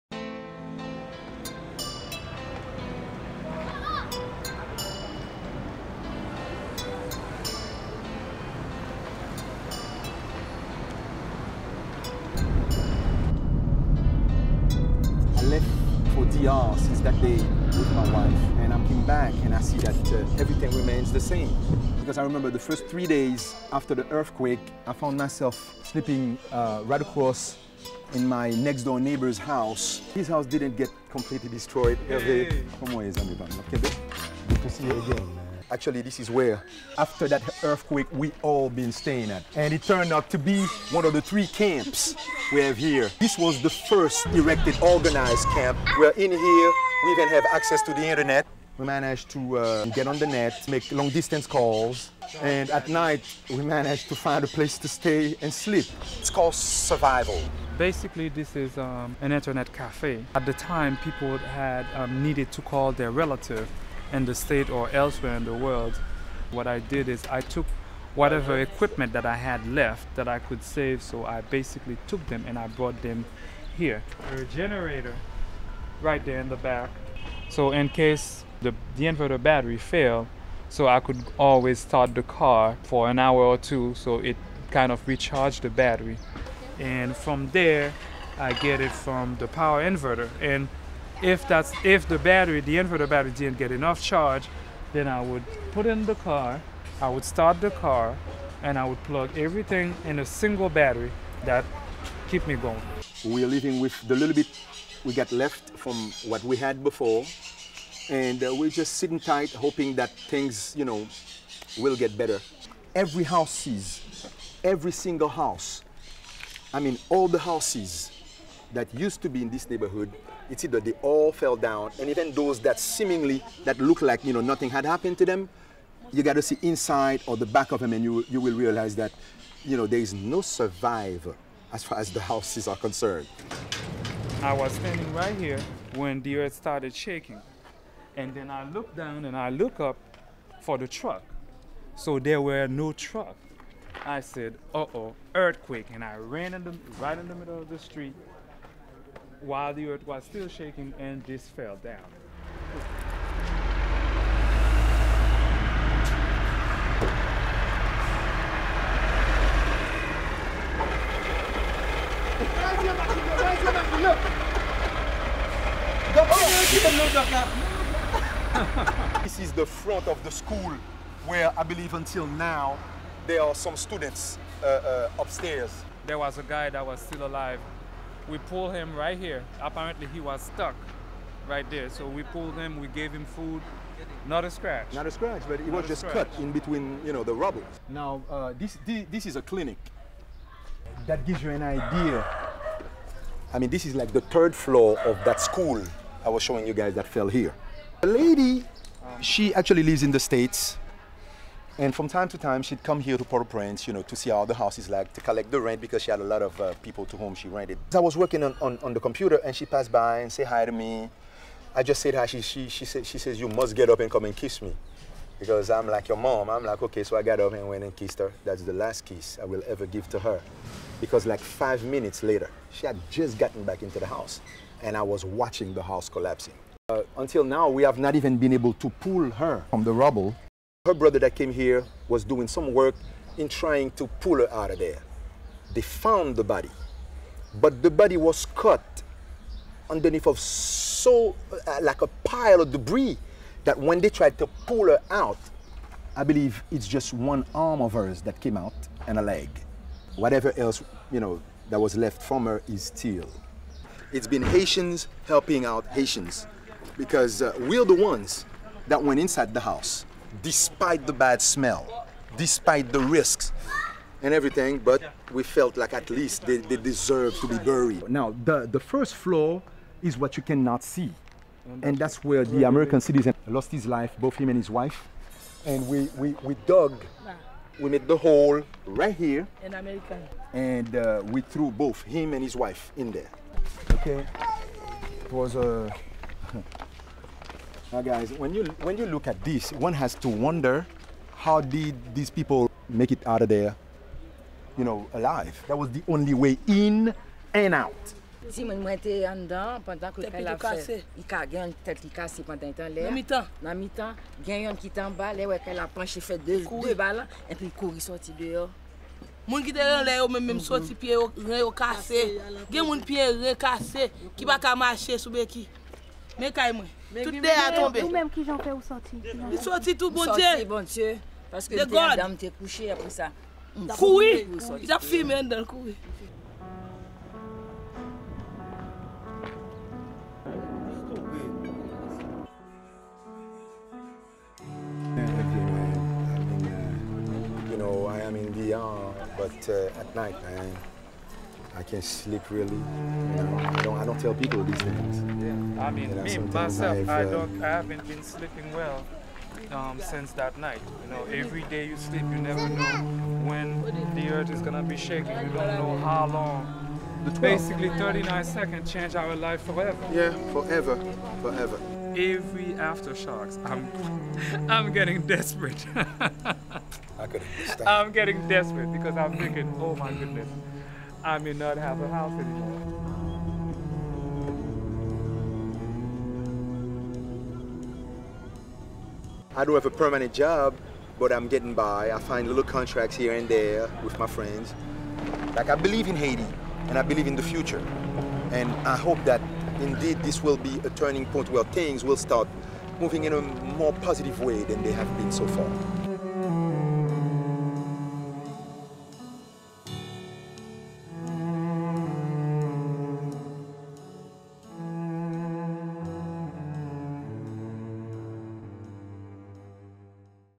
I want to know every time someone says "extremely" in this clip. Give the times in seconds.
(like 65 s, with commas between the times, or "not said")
not said.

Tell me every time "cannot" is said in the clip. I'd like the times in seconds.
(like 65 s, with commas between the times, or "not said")
270 s.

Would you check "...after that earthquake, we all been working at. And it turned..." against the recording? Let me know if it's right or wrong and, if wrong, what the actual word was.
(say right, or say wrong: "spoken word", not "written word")
wrong: "staying", not "working".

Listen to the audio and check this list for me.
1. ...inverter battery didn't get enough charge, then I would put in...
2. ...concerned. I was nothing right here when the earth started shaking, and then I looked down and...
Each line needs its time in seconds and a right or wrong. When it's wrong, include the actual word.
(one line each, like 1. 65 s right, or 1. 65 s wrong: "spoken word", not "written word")
1. 92 s right
2. 132 s wrong: "standing", not "nothing".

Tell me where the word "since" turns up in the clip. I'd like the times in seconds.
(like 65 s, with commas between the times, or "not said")
16 s, 349 s.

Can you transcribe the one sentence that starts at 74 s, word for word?
A generator right there in the back.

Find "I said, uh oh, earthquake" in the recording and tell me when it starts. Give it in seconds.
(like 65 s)
144 s.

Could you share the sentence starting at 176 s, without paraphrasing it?
There was a guy that was still alive we pulled him right here.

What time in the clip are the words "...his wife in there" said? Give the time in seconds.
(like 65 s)
282 s.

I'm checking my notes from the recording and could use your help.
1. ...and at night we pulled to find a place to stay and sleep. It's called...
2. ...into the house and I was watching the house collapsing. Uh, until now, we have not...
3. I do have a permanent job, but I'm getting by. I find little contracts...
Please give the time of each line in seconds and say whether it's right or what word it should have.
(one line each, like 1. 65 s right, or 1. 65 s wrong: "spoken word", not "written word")
1. 52 s wrong: "managed", not "pulled"
2. 223 s right
3. 379 s right.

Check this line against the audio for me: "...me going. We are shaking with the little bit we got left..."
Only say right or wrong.
wrong.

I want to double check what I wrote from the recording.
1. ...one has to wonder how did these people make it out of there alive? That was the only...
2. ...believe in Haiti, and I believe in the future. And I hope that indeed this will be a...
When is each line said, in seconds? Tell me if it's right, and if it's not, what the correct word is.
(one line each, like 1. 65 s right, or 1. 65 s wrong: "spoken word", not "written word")
1. 289 s right
2. 385 s right.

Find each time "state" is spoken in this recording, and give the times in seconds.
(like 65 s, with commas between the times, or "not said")
64 s, 200 s.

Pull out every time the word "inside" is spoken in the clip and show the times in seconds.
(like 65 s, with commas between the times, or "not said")
126 s, 259 s.